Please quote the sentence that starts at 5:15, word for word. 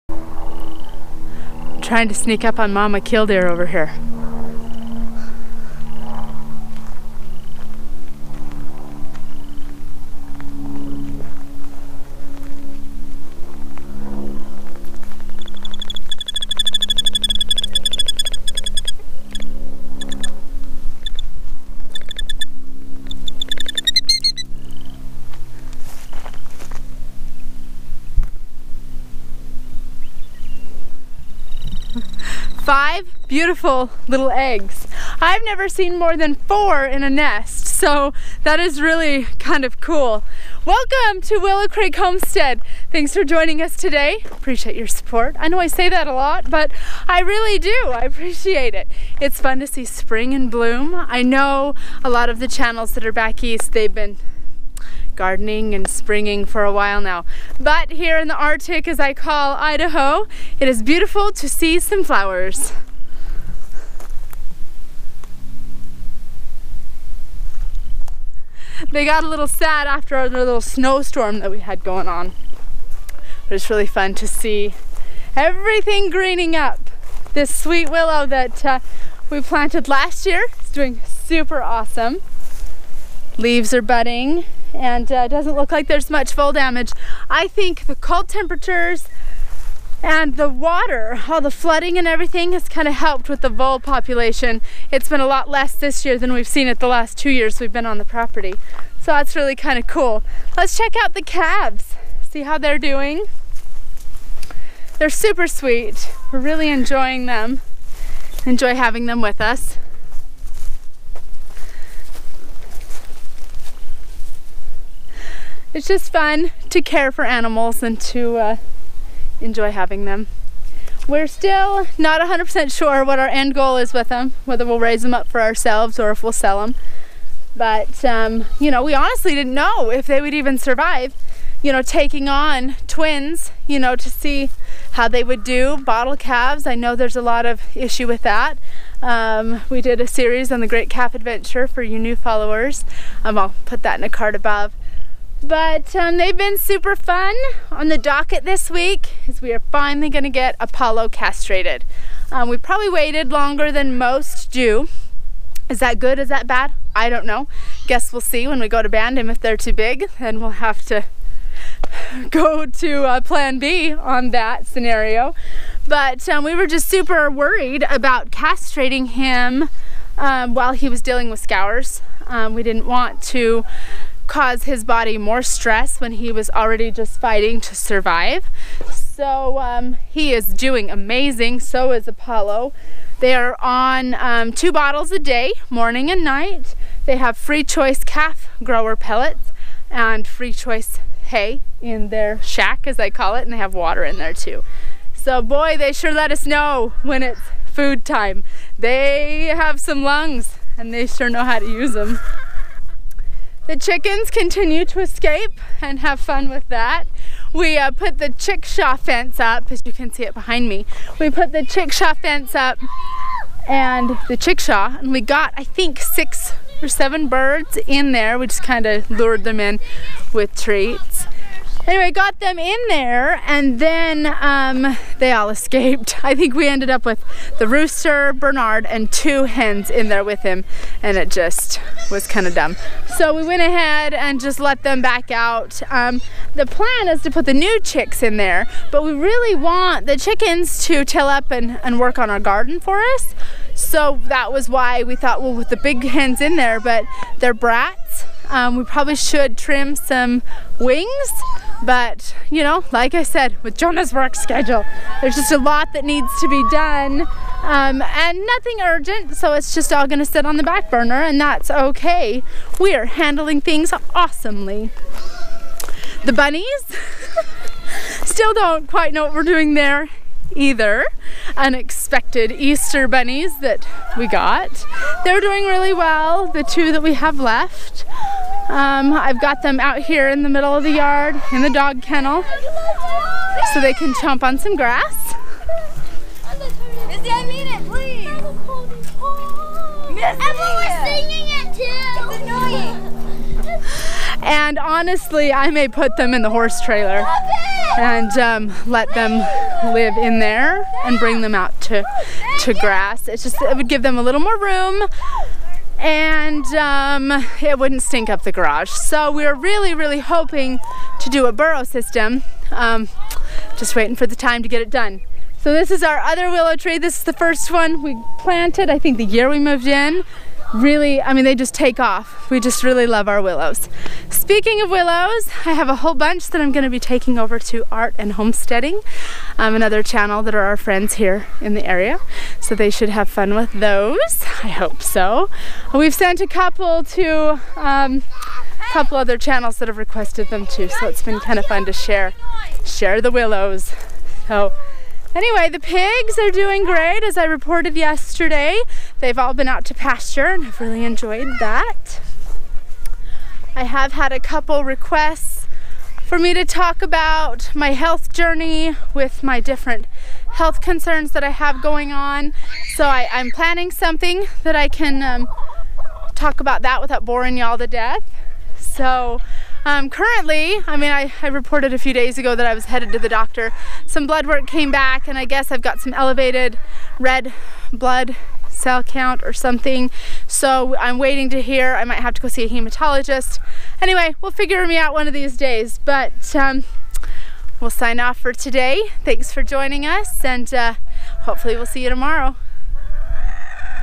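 So this is our other willow tree.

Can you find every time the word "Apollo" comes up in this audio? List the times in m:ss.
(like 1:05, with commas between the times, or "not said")
2:30, 3:02.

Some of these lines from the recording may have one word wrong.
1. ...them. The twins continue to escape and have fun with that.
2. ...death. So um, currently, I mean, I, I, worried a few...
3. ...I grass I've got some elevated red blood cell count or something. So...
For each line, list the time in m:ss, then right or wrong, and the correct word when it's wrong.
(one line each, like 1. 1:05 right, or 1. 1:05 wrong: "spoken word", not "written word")
1. 3:21 wrong: "chickens", not "twins"
2. 6:07 wrong: "reported", not "worried"
3. 6:15 wrong: "guess", not "grass".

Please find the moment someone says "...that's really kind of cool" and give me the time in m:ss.
1:39.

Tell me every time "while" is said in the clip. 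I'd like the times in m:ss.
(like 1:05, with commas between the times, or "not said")
0:56, 2:50.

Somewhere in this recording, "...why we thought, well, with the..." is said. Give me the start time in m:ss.
4:04.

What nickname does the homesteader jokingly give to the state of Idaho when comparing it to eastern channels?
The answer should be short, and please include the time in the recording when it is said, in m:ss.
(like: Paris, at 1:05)
the Arctic, at 0:58.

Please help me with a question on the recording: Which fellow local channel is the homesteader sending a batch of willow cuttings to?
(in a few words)
Art and Homesteading.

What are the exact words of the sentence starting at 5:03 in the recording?
It's just, it would give them a little more room and um, it wouldn't stink up the garage.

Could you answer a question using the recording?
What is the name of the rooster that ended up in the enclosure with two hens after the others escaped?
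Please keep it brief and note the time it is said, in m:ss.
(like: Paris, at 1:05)
Bernard, at 3:48.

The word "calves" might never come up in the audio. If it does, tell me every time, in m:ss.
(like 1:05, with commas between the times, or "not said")
1:41, 2:16.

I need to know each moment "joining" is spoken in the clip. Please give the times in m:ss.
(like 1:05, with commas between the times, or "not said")
0:43, 6:29.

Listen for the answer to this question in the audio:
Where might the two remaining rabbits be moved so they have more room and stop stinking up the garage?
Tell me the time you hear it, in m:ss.
4:56.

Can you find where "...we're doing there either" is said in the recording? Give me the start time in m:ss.
4:29.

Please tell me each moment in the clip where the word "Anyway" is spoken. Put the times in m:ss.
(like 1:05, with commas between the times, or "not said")
3:41, 5:45, 6:24.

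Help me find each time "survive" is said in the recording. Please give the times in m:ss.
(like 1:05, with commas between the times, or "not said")
2:10, 2:57.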